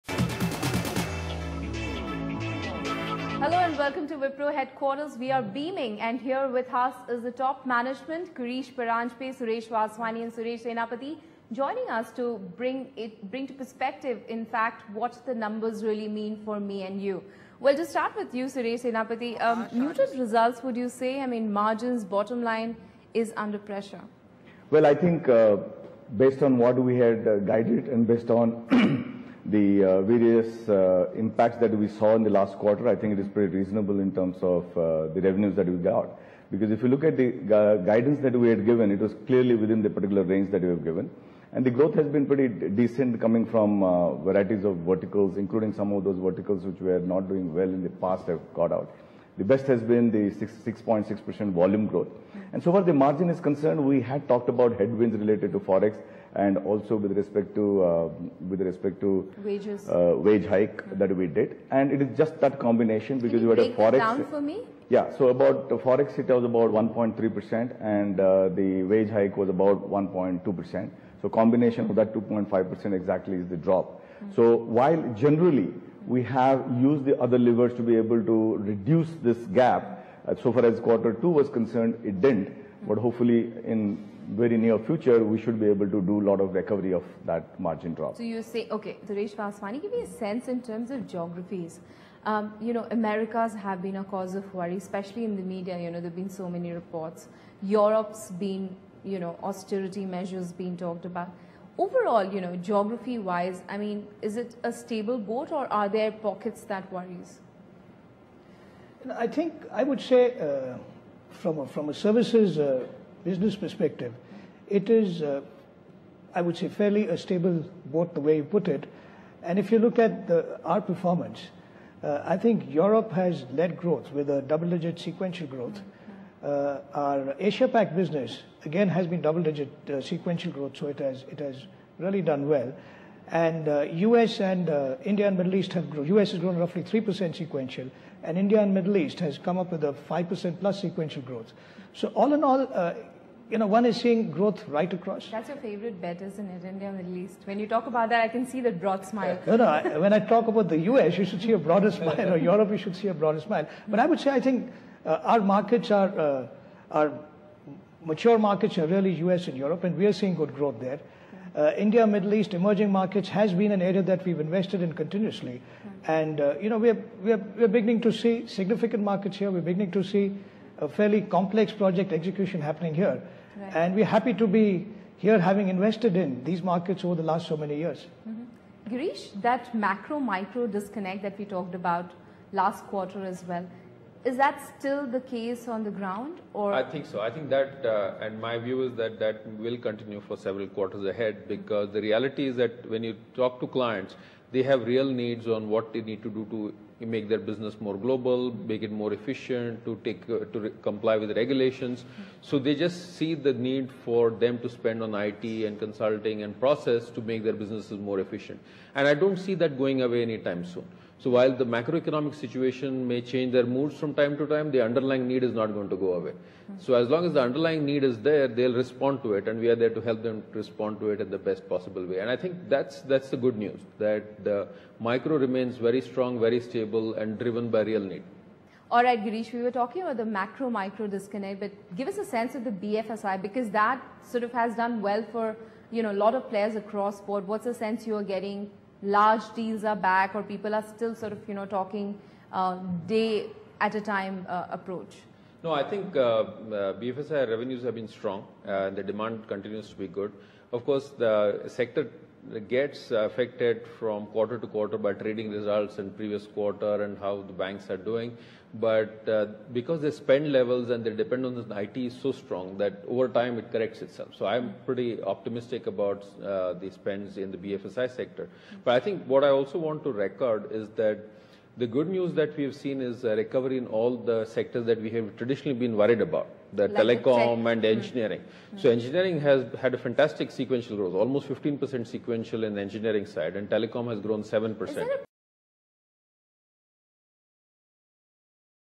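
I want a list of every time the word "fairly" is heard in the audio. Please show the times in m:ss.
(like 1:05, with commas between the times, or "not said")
1:56, 2:50.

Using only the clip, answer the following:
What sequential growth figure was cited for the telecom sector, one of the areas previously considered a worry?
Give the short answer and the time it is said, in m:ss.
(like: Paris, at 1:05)
7%, at 4:44.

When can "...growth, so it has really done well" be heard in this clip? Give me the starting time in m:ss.
2:10.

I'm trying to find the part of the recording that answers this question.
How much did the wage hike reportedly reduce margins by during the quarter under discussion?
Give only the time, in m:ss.
1:09.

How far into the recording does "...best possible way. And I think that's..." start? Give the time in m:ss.
3:41.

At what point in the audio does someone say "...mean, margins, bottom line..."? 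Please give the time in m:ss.
0:21.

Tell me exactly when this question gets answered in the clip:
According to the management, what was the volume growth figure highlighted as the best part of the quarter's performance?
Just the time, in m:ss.
0:50.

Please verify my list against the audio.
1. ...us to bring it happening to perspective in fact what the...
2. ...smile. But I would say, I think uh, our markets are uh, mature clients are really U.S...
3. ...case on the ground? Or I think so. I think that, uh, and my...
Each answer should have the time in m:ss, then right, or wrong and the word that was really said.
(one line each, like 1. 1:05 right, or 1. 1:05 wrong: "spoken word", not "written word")
1. 0:11 wrong: "bring", not "happening"
2. 2:33 wrong: "markets", not "clients"
3. 3:05 right.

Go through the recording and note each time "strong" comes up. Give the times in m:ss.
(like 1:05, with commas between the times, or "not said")
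3:46, 4:08, 4:22.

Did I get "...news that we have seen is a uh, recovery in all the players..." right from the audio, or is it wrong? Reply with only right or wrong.
wrong.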